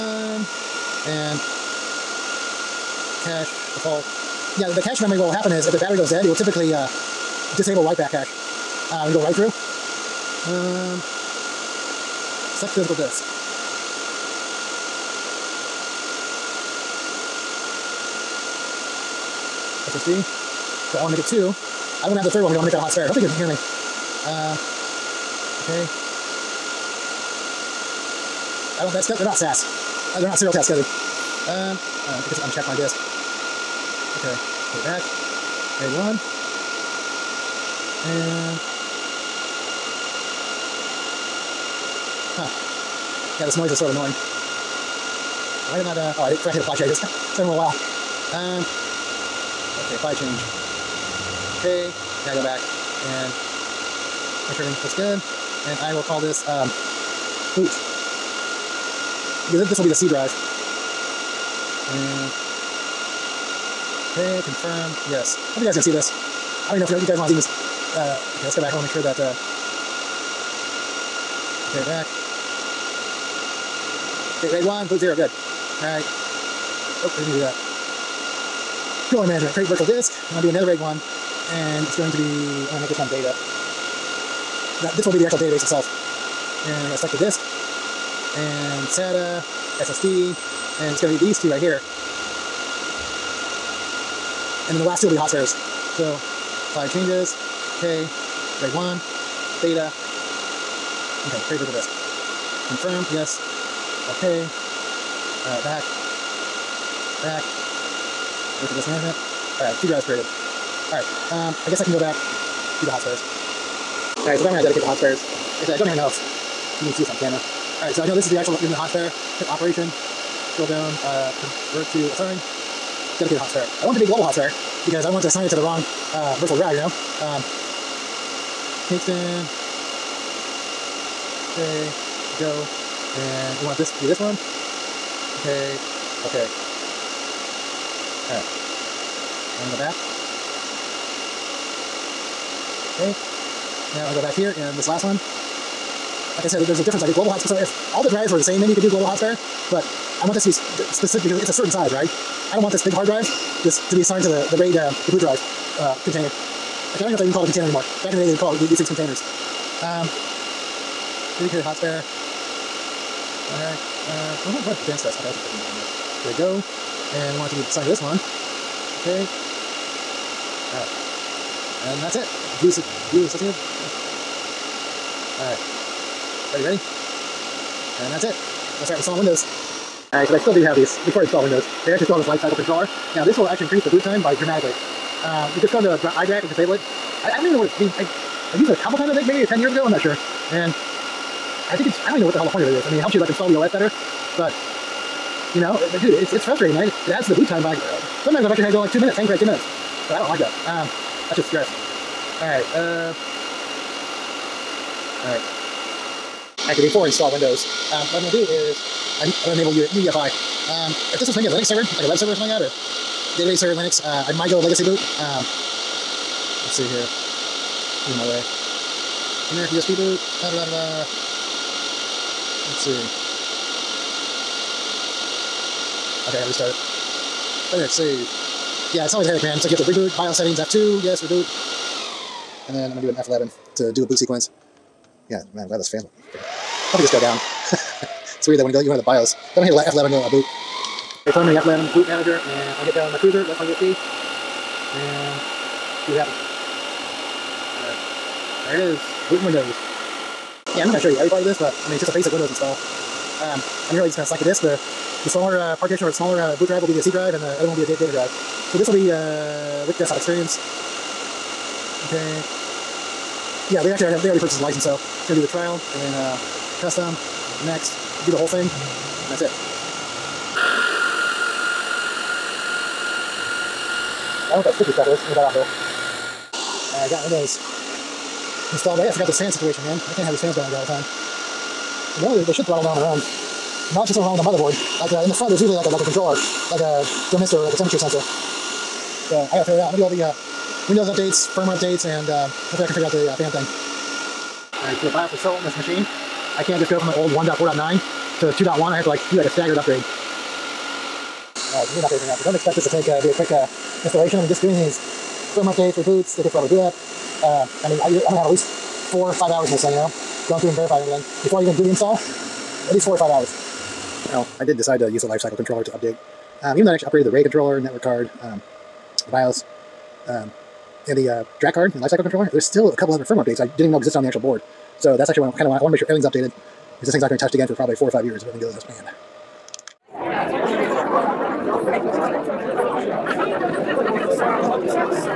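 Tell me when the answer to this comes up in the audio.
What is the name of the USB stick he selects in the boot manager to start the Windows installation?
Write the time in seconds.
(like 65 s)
243 s.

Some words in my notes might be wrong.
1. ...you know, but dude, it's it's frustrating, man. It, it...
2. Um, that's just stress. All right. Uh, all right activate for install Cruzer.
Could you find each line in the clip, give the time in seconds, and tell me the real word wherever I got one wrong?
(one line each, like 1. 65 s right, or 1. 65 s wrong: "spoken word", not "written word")
1. 195 s right
2. 200 s wrong: "Windows", not "Cruzer".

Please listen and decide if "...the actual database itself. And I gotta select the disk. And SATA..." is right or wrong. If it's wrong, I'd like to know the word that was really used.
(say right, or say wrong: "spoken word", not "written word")
right.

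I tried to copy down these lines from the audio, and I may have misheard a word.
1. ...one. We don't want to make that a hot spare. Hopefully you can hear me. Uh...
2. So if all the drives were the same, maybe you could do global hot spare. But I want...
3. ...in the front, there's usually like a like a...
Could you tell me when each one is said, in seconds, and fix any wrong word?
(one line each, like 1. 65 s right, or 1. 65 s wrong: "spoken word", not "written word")
1. 22 s right
2. 147 s right
3. 285 s right.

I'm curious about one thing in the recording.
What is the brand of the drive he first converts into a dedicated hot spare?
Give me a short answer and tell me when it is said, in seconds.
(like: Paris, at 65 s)
Kingston, at 128 s.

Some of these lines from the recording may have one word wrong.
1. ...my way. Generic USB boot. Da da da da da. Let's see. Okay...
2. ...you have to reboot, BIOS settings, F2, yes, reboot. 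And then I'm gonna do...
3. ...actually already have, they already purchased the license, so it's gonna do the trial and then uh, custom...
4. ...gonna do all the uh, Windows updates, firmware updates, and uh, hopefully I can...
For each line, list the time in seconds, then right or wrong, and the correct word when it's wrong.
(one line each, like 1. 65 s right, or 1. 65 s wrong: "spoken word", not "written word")
1. 218 s right
2. 229 s right
3. 263 s right
4. 289 s right.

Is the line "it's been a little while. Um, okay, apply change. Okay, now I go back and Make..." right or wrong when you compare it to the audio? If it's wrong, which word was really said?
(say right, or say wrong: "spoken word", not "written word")
right.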